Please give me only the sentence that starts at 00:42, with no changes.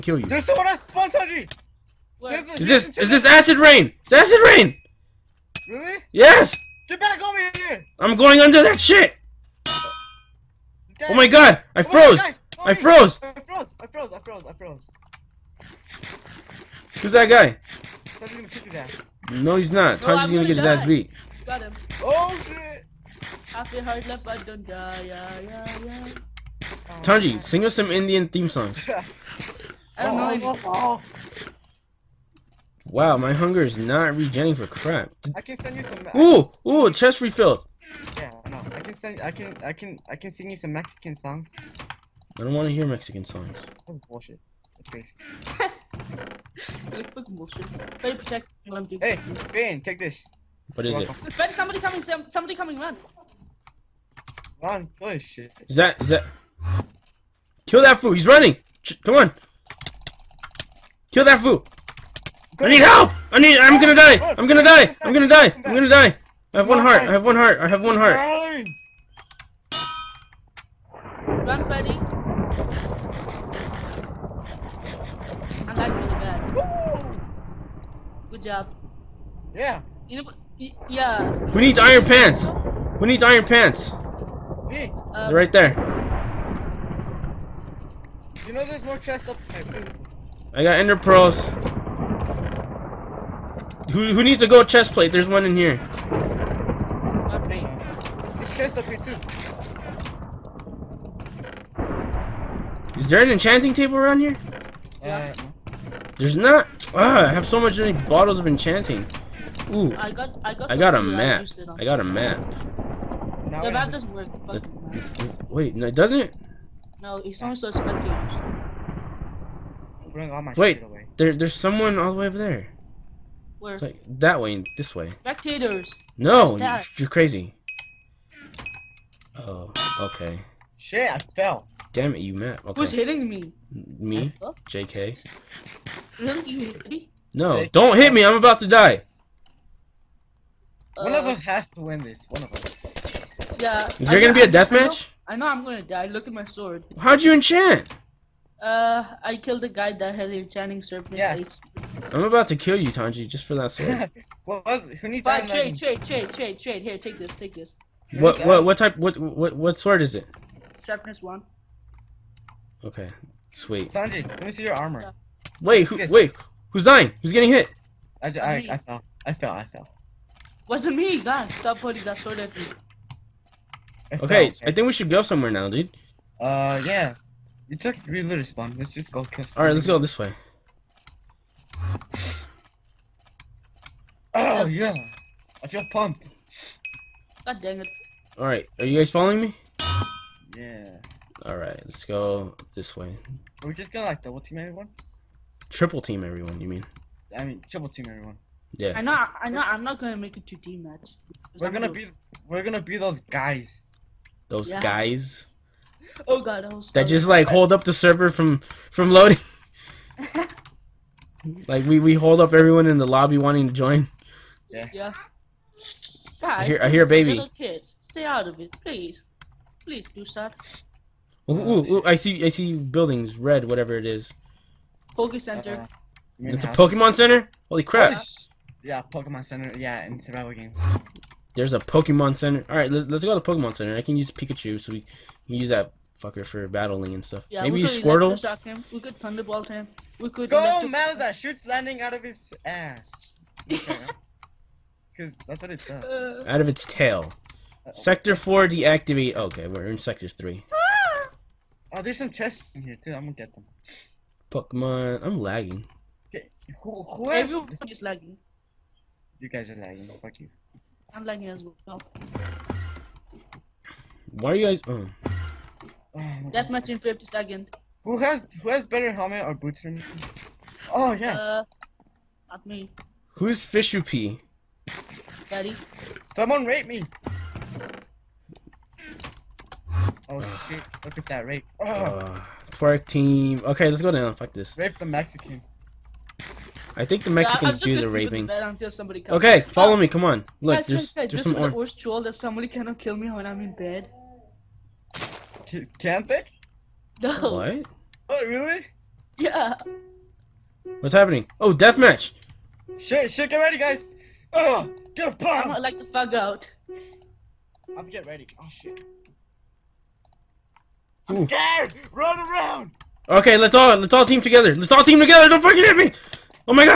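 I don't want to hear Mexican songs.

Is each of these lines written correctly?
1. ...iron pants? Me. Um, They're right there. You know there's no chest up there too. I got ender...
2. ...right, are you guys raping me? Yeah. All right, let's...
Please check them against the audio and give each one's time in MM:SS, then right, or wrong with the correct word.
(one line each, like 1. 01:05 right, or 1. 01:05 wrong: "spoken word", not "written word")
1. 01:23 right
2. 03:08 wrong: "following", not "raping".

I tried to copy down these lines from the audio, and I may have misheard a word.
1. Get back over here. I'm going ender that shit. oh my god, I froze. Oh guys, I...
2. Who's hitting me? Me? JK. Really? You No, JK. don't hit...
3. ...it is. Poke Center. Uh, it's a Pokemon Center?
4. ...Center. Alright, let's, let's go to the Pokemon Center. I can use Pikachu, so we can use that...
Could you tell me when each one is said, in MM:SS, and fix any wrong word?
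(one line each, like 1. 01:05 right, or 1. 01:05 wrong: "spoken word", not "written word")
1. 00:06 wrong: "under", not "ender"
2. 02:12 right
3. 03:43 right
4. 03:52 right.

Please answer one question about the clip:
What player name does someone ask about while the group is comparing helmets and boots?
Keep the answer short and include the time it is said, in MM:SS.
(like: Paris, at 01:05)
Fishu P, at 04:33.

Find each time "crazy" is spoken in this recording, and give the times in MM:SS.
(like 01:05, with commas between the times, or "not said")
00:44, 02:07.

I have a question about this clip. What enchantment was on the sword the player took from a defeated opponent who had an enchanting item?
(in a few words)
Sharpness 1.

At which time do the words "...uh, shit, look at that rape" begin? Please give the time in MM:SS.
04:40.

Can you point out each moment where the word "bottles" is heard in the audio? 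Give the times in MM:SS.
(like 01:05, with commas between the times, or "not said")
01:48.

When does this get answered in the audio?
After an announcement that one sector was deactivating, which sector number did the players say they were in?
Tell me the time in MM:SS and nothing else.
04:09.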